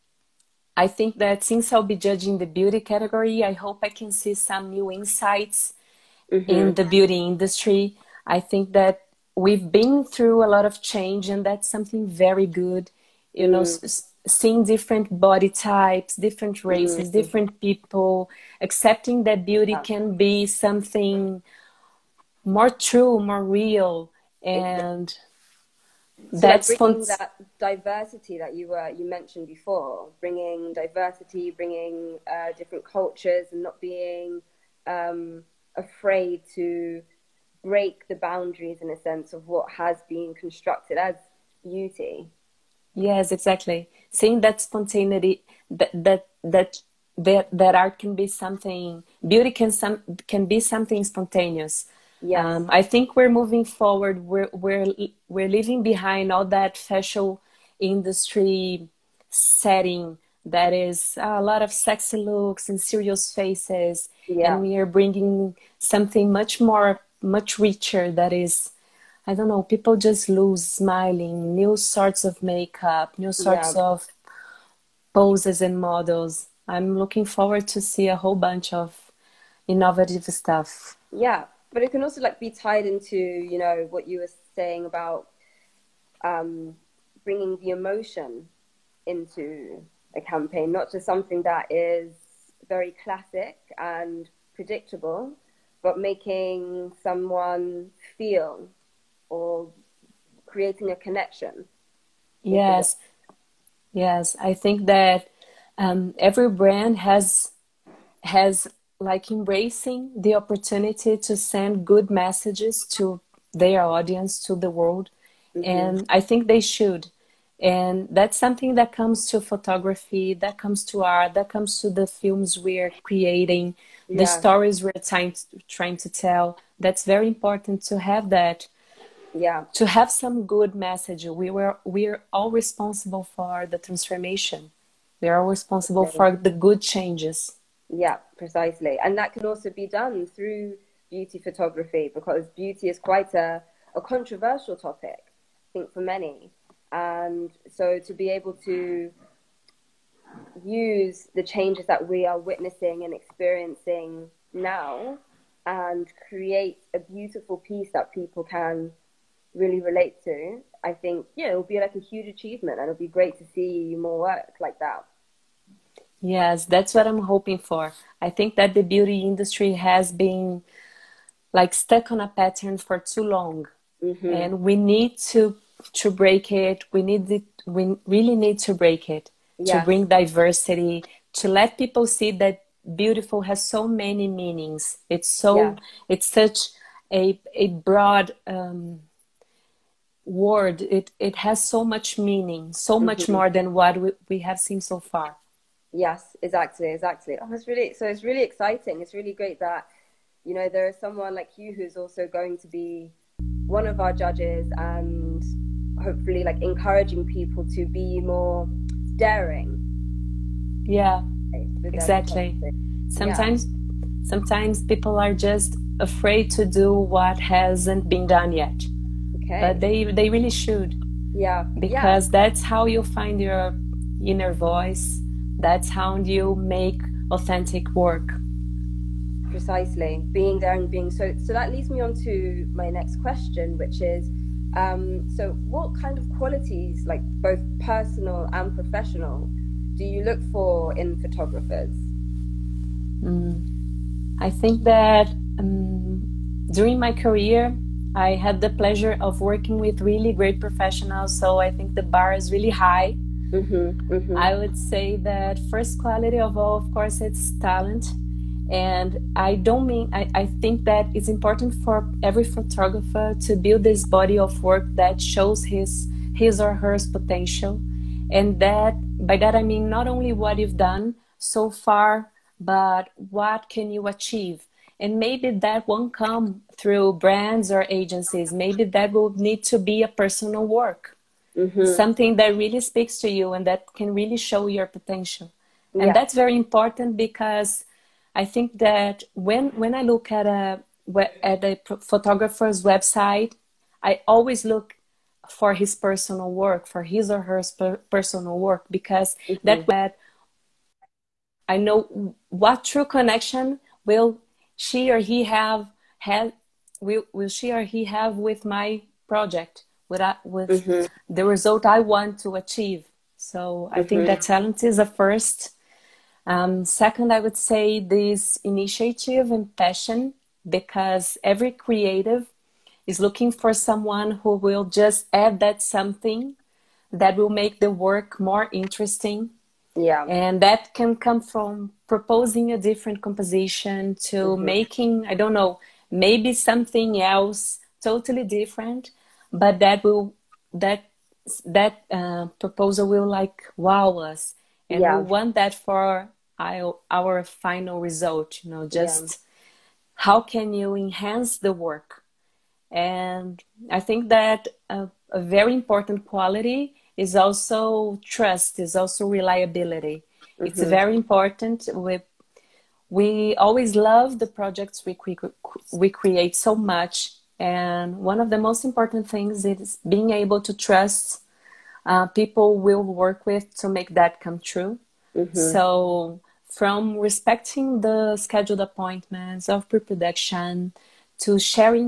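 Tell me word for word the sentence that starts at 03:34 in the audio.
sometimes people are just afraid to do what hasn't been done yet Okay.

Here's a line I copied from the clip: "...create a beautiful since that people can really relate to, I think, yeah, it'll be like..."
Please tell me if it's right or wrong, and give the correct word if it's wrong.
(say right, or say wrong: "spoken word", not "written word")
wrong: "piece", not "since".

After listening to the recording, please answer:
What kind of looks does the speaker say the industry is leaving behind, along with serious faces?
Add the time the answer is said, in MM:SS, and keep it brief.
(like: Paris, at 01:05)
Sexy looks, at 01:01.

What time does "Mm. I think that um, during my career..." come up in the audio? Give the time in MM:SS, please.
04:03.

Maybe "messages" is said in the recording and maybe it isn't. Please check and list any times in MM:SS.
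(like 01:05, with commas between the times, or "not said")
01:52, 02:10.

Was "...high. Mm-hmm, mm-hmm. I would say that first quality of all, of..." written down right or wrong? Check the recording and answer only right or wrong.
right.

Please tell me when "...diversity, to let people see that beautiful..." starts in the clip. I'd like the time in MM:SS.
03:00.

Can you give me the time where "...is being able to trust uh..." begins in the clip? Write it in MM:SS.
06:09.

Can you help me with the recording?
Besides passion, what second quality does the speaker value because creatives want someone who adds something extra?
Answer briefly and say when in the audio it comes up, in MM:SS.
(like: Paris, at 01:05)
Initiative, at 05:18.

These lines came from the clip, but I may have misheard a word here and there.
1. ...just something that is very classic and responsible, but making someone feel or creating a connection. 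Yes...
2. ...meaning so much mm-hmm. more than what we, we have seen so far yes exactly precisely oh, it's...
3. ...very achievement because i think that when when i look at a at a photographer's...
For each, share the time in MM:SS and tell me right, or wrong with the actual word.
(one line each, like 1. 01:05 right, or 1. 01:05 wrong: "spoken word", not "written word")
1. 01:30 wrong: "predictable", not "responsible"
2. 03:12 wrong: "exactly", not "precisely"
3. 04:46 wrong: "important", not "achievement".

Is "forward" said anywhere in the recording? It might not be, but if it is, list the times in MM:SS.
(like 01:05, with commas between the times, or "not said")
00:53, 01:17.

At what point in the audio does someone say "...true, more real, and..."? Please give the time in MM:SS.
00:22.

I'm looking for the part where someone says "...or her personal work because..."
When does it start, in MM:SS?
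04:57.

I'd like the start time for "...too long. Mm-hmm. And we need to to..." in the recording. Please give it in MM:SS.
02:52.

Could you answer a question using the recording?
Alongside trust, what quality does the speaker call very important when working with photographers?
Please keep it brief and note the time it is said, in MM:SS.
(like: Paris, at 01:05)
Reliability, at 05:59.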